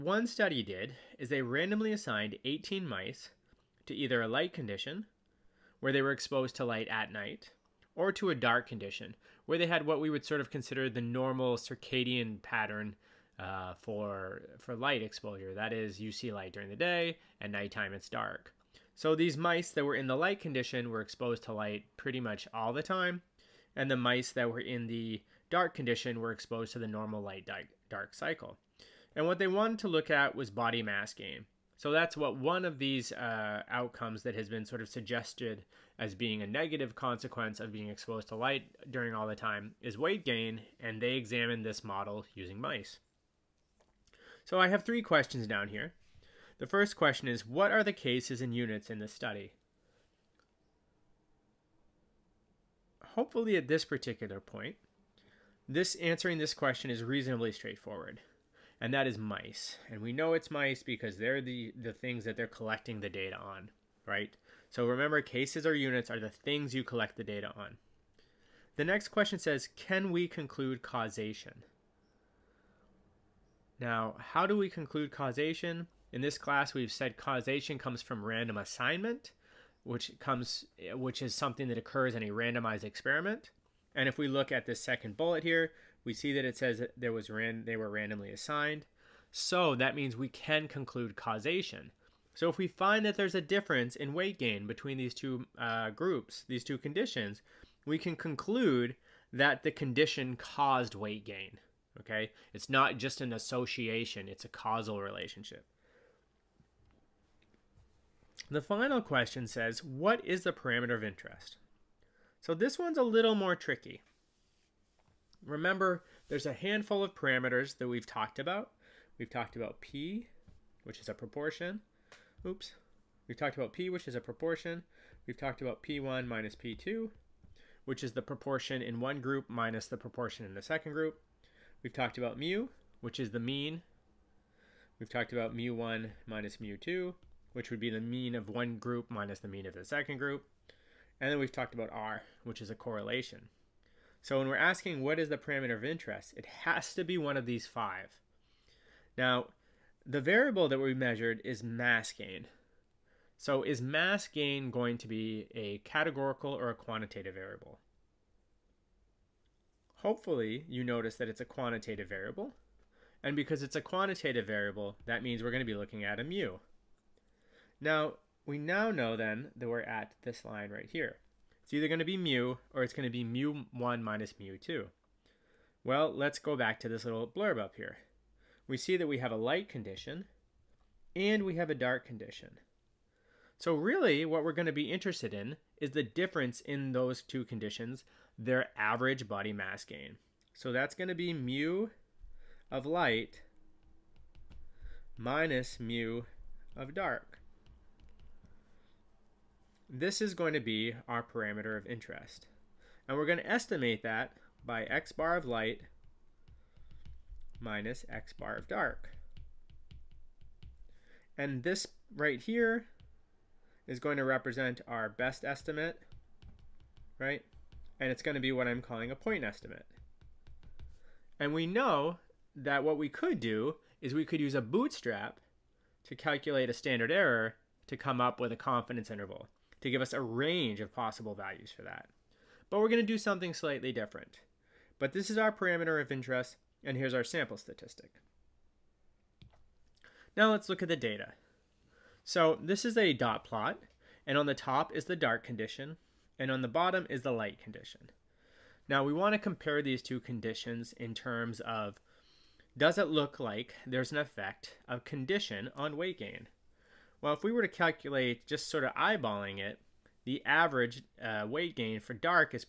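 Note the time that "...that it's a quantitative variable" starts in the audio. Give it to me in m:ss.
2:41.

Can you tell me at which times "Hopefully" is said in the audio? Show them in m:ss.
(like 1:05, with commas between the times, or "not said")
0:53, 2:39.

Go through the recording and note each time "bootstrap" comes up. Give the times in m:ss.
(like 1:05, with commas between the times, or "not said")
3:44.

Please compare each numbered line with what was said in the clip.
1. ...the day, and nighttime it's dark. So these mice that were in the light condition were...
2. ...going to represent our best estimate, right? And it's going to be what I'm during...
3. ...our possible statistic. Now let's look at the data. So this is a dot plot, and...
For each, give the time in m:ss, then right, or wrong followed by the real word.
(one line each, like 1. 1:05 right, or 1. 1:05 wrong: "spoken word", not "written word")
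1. 0:16 right
2. 3:33 wrong: "calling", not "during"
3. 3:57 wrong: "sample", not "possible".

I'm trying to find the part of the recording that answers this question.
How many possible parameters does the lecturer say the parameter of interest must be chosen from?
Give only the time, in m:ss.
2:27.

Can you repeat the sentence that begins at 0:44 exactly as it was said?
So I have three questions down here.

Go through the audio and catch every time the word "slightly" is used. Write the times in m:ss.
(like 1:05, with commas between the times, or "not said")
3:53.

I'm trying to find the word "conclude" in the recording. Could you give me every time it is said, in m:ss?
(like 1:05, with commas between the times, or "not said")
1:10, 1:14, 1:30, 1:38.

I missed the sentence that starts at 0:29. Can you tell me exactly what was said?
And what they wanted to look at was body mass gain.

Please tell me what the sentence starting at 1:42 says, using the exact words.
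Okay, it's not just an association; it's a causal relationship.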